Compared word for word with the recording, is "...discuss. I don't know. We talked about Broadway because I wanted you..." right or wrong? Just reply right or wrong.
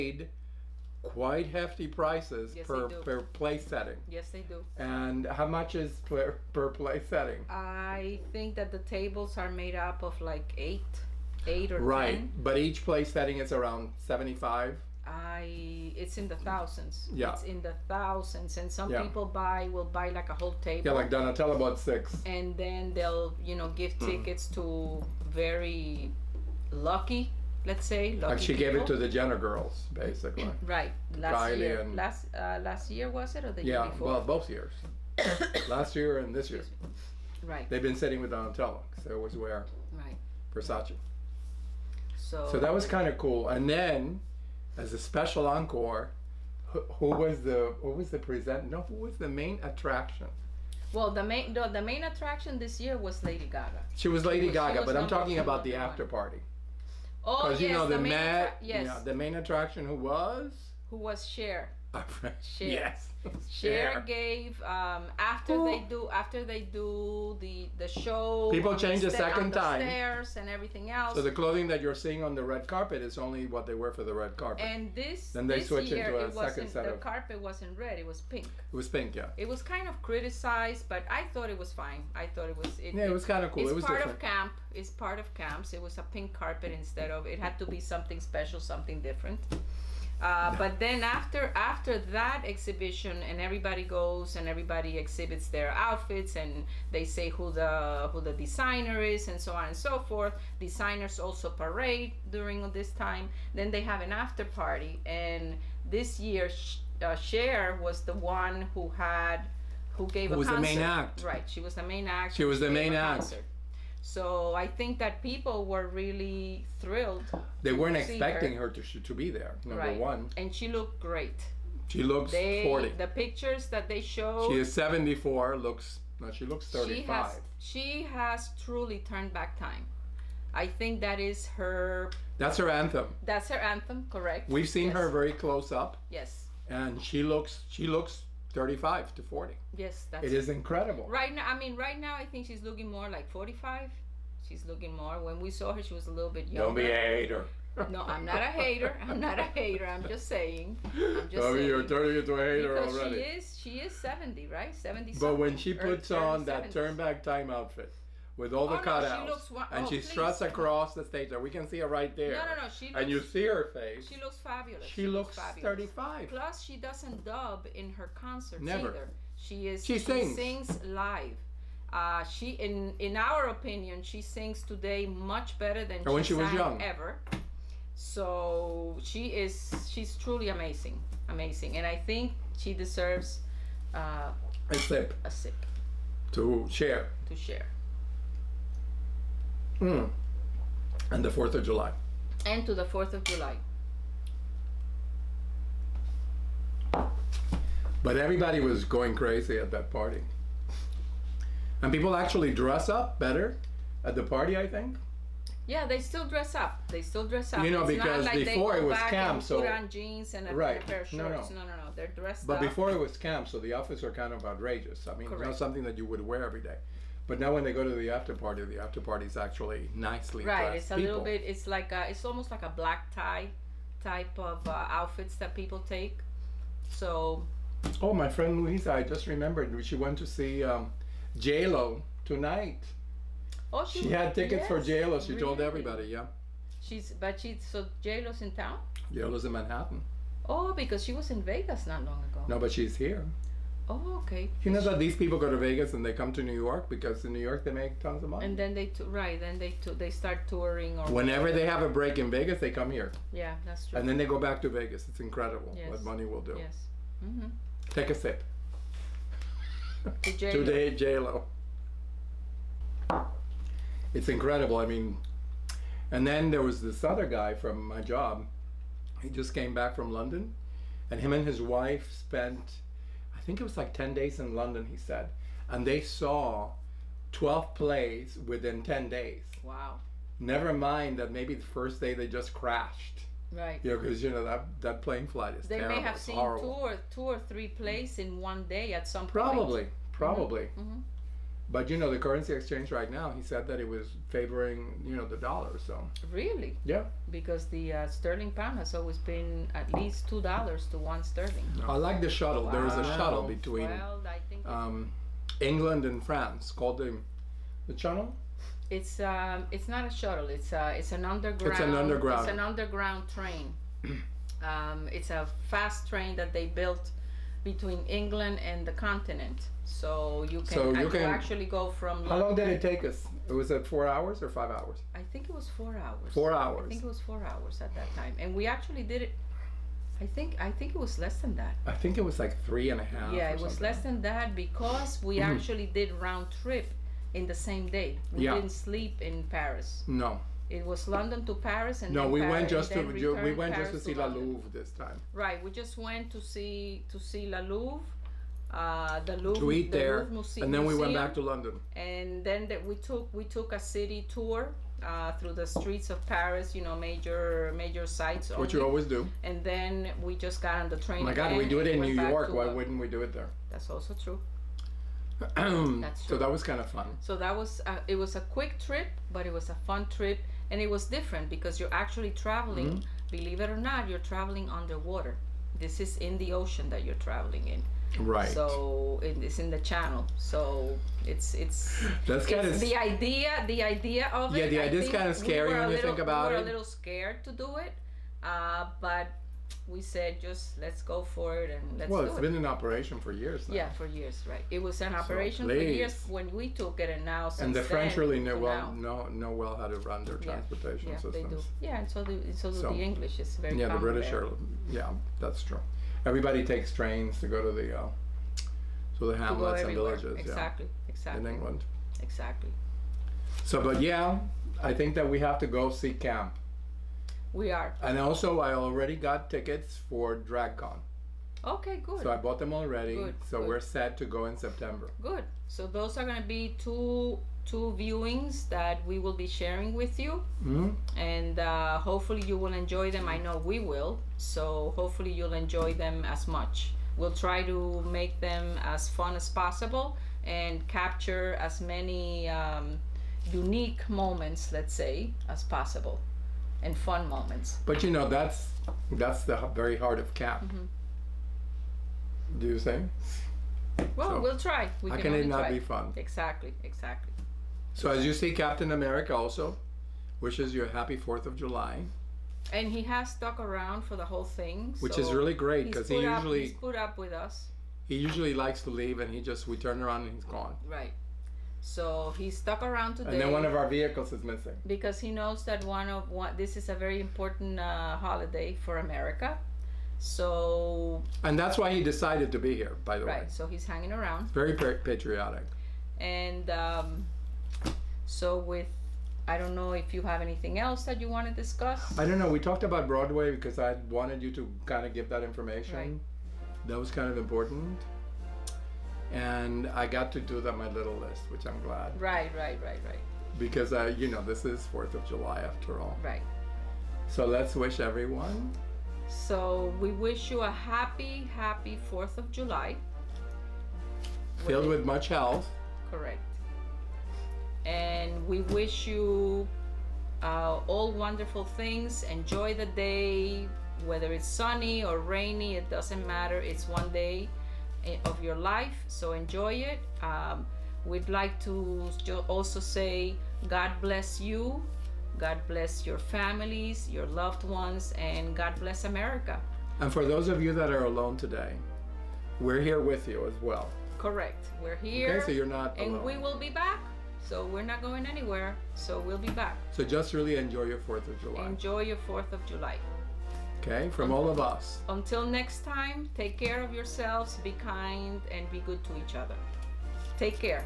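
right.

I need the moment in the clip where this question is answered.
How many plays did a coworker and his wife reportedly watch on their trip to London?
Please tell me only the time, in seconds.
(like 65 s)
277 s.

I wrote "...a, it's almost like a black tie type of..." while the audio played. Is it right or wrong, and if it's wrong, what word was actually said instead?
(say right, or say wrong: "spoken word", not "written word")
right.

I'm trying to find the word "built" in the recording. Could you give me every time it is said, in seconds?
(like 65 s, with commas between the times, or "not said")
316 s.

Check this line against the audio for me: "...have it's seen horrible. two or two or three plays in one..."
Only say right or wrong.
right.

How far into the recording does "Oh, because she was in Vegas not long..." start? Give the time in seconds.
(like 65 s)
240 s.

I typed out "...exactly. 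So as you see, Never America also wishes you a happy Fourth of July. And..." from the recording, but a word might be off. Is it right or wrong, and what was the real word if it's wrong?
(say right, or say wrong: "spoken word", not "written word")
wrong: "Captain", not "Never".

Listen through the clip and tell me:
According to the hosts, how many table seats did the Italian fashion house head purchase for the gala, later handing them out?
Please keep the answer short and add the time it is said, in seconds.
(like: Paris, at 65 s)
6, at 21 s.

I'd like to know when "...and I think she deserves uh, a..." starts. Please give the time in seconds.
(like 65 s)
181 s.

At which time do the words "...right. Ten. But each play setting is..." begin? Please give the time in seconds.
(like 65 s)
11 s.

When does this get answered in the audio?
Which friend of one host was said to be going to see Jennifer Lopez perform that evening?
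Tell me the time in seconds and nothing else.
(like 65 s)
228 s.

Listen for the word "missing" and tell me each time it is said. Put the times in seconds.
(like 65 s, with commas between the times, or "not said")
474 s.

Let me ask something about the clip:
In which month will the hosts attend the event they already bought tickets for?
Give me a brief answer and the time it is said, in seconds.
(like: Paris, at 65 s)
September, at 424 s.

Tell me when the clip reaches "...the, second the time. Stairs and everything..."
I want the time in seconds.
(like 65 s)
69 s.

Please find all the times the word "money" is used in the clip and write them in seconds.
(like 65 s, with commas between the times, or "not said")
248 s, 256 s.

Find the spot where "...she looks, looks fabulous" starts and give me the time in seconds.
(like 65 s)
165 s.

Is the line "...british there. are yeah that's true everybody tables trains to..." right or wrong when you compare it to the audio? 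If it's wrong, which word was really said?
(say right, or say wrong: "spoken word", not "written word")
wrong: "takes", not "tables".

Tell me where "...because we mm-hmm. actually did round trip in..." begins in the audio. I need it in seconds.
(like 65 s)
334 s.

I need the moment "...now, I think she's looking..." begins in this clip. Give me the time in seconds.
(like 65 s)
141 s.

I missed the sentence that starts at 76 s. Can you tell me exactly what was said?
The carpet wasn't red; it was pink.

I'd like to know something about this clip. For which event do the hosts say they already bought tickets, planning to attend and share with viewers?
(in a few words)
DragCon.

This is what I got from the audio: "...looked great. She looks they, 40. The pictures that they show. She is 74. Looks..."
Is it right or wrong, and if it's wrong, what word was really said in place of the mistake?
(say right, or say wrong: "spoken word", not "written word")
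right.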